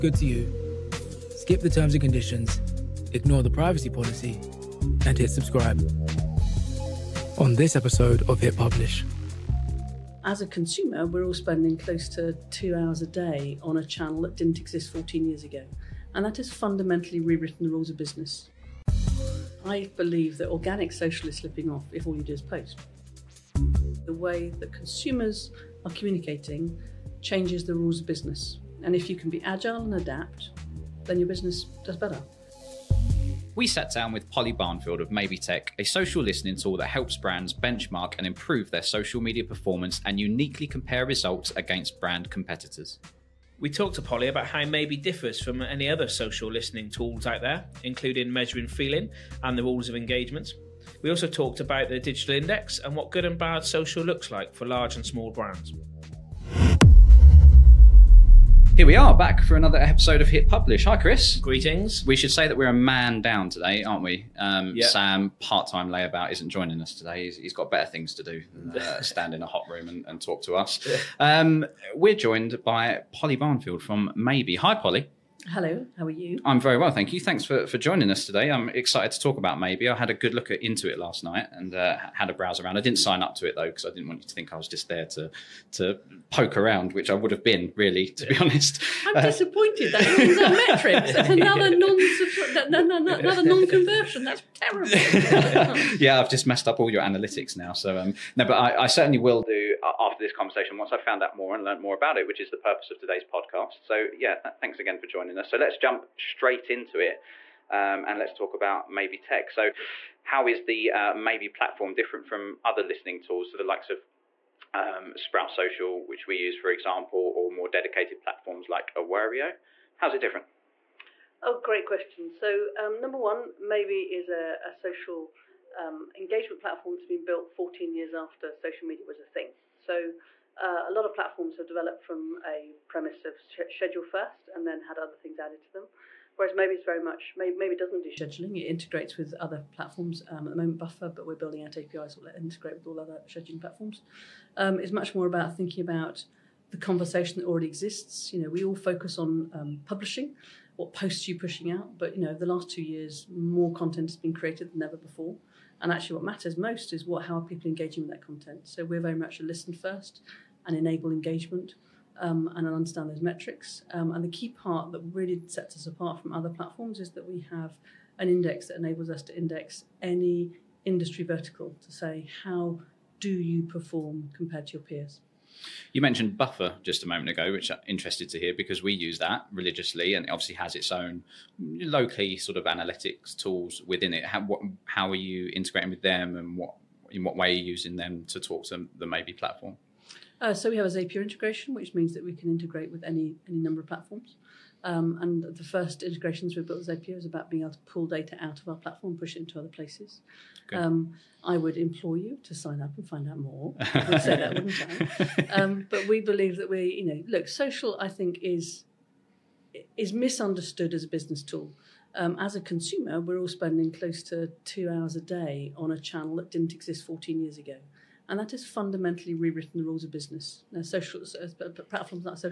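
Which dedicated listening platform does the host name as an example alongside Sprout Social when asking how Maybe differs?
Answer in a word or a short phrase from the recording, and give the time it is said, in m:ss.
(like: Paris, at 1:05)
Awario, at 1:58.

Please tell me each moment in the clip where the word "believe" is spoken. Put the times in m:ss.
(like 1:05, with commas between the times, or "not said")
0:19, 3:26.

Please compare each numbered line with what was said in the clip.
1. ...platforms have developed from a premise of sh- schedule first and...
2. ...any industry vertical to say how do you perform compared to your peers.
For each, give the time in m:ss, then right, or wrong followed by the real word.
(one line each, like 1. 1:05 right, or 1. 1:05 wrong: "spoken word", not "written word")
1. 2:11 right
2. 2:50 right.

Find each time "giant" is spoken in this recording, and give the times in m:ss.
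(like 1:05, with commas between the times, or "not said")
not said.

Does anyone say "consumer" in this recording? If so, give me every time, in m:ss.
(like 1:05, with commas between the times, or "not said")
0:10, 0:24, 3:32.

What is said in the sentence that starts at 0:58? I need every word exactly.
Here we are back for another episode of Hit Publish.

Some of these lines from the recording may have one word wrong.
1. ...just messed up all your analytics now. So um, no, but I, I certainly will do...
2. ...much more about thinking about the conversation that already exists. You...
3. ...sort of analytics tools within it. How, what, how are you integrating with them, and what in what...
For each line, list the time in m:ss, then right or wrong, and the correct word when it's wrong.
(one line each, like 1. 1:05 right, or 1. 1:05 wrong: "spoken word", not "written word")
1. 1:36 right
2. 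2:24 right
3. 3:02 right.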